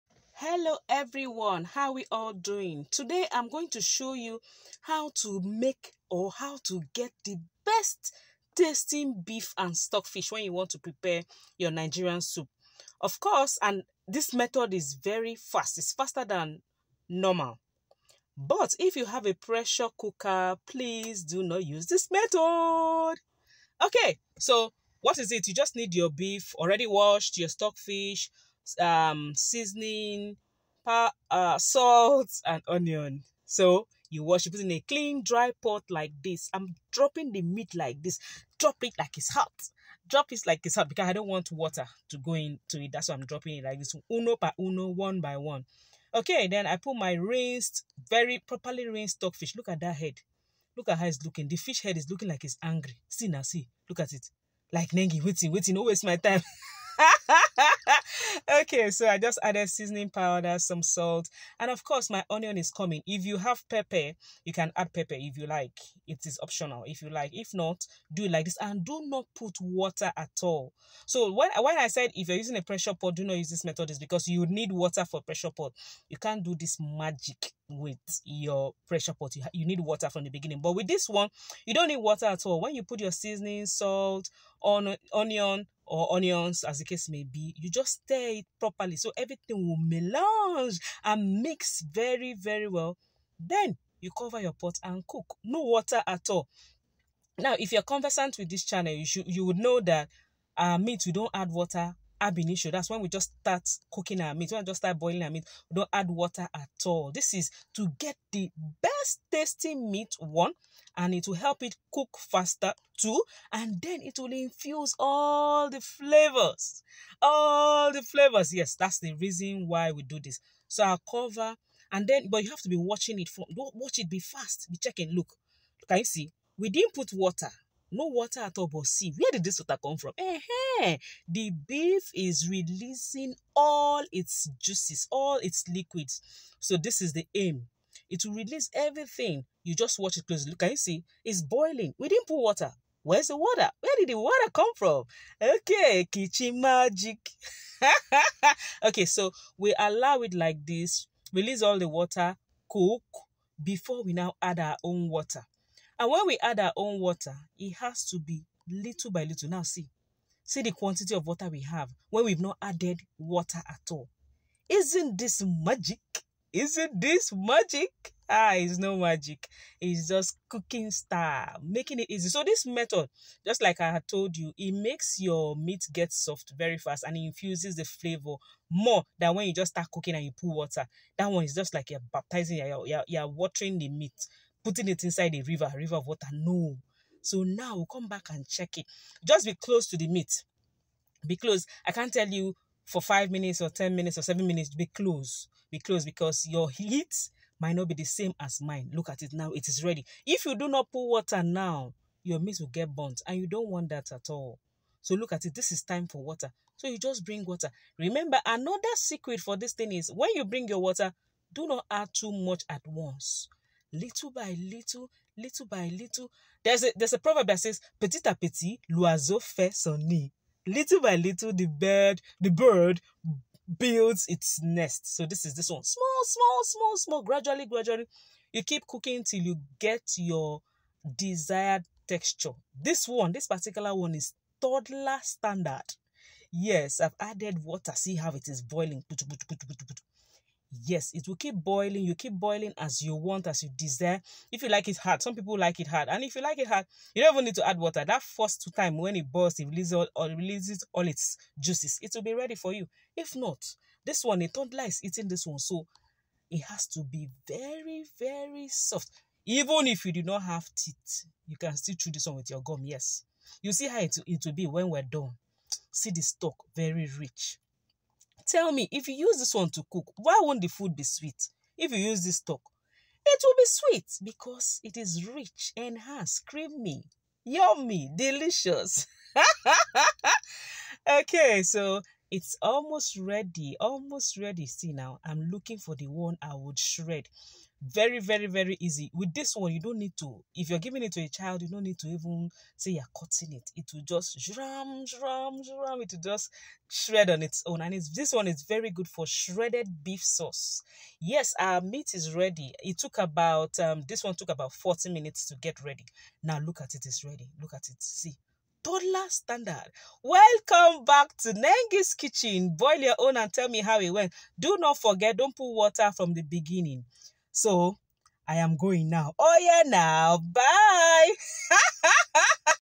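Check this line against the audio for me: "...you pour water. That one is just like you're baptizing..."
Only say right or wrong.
right.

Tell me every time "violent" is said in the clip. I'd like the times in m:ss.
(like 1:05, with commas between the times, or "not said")
not said.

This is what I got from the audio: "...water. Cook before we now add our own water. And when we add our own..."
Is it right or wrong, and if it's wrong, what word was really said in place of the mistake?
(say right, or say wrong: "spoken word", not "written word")
right.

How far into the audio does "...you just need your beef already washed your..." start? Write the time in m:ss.
0:25.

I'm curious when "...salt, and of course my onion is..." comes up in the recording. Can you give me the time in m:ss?
1:00.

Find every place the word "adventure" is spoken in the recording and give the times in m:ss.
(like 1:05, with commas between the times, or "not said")
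not said.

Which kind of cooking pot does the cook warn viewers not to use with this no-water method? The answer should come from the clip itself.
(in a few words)
Pressure cooker.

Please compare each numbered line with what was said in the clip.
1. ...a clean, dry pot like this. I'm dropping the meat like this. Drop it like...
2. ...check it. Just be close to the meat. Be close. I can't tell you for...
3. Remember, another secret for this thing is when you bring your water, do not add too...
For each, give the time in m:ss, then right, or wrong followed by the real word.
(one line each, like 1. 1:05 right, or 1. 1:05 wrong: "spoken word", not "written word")
1. 0:34 right
2. 3:08 right
3. 3:27 right.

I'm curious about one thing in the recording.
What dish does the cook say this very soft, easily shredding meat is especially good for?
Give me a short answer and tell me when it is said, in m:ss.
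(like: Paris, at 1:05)
Shredded beef sauce, at 4:59.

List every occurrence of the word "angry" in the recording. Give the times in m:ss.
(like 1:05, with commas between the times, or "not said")
0:52.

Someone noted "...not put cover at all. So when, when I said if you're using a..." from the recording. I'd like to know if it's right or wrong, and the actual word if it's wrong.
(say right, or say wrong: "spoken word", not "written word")
wrong: "water", not "cover".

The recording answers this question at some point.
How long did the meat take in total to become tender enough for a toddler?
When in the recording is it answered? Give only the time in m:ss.
5:04.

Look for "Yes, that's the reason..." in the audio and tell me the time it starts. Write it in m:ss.
1:58.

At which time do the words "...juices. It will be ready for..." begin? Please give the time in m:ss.
4:11.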